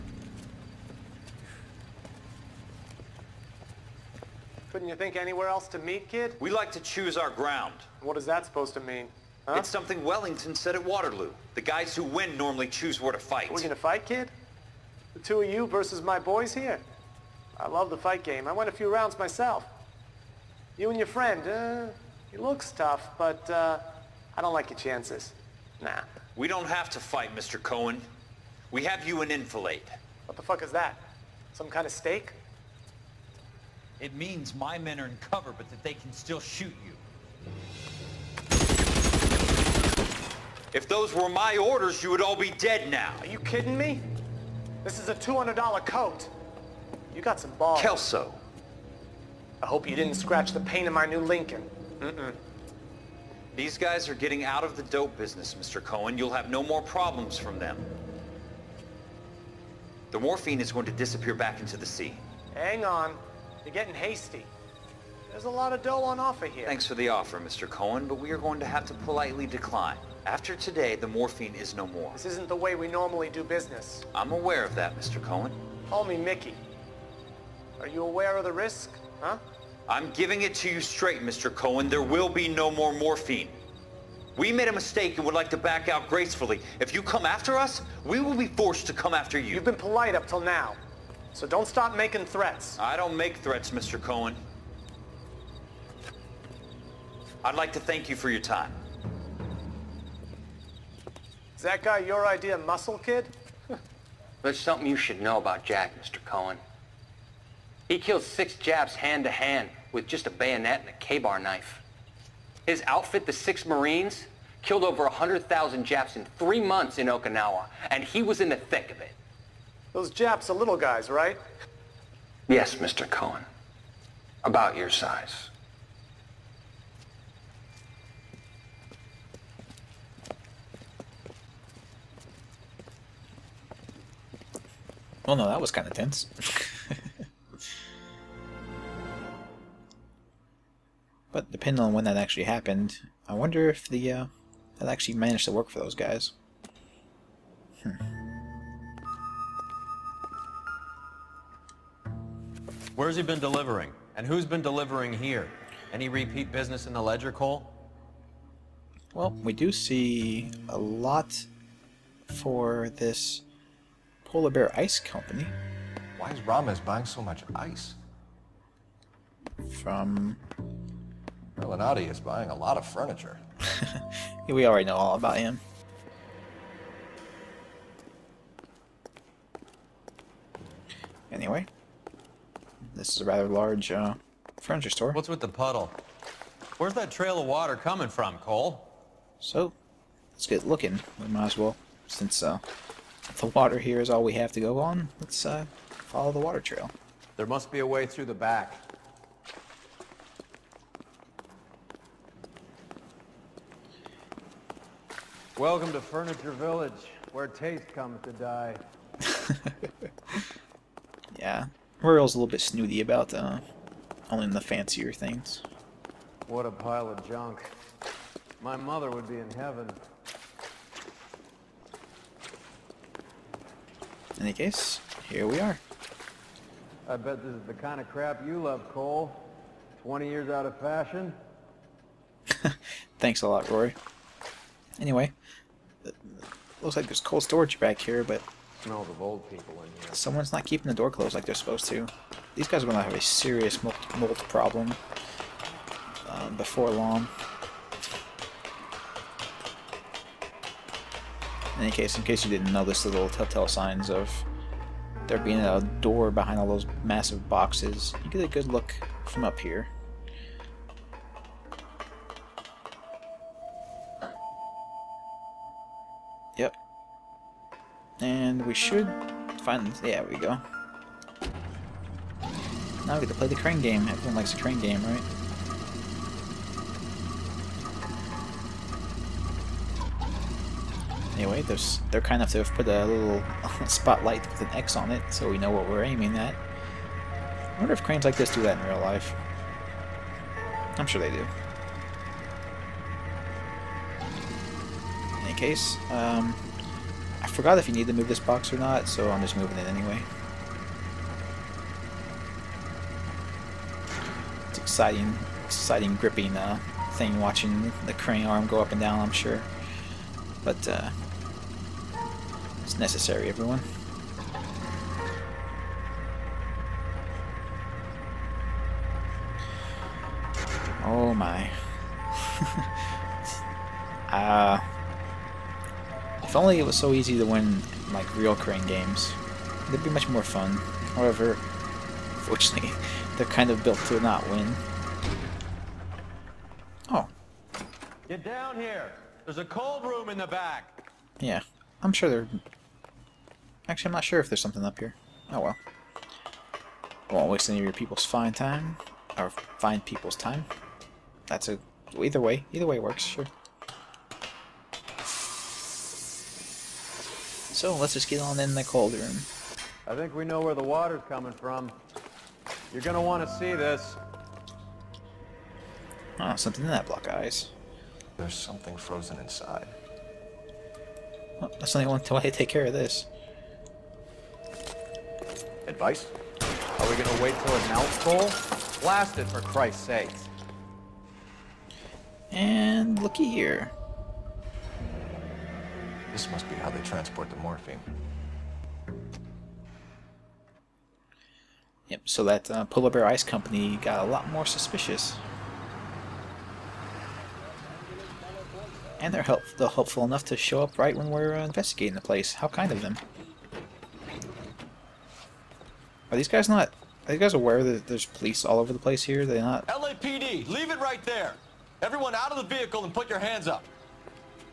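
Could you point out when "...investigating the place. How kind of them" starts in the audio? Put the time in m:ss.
6:41.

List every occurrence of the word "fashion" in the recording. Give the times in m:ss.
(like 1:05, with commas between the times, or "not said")
3:50.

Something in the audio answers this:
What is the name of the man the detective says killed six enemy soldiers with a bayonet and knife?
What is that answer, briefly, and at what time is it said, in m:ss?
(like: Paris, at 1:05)
Jack, at 1:45.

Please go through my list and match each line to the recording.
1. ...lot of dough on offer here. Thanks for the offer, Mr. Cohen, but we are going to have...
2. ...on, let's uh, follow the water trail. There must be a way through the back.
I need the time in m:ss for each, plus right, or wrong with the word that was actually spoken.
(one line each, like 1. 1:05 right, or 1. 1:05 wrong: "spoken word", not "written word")
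1. 1:05 right
2. 3:14 right.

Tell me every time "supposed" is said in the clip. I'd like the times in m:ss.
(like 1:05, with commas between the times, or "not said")
0:08, 4:01.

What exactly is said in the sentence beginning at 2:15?
Well, no, that was kind of tense.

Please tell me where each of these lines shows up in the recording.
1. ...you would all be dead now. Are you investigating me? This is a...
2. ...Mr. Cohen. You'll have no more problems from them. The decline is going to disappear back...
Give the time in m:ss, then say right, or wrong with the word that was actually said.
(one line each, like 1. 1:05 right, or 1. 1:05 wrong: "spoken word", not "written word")
1. 0:42 wrong: "kidding", not "investigating"
2. 0:55 wrong: "morphine", not "decline".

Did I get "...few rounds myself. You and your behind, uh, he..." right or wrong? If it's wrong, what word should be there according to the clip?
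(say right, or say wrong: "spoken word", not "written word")
wrong: "friend", not "behind".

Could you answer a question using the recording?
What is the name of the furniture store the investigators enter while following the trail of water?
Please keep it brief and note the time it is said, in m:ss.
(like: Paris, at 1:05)
Furniture Village, at 3:25.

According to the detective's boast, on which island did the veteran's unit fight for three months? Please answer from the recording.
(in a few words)
Okinawa.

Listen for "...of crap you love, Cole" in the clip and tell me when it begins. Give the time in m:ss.
3:48.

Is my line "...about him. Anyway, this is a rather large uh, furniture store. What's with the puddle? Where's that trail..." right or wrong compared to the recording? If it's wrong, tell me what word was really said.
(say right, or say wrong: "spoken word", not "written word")
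right.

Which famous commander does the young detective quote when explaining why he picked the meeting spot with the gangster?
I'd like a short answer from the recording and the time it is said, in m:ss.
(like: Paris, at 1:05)
Wellington, at 0:10.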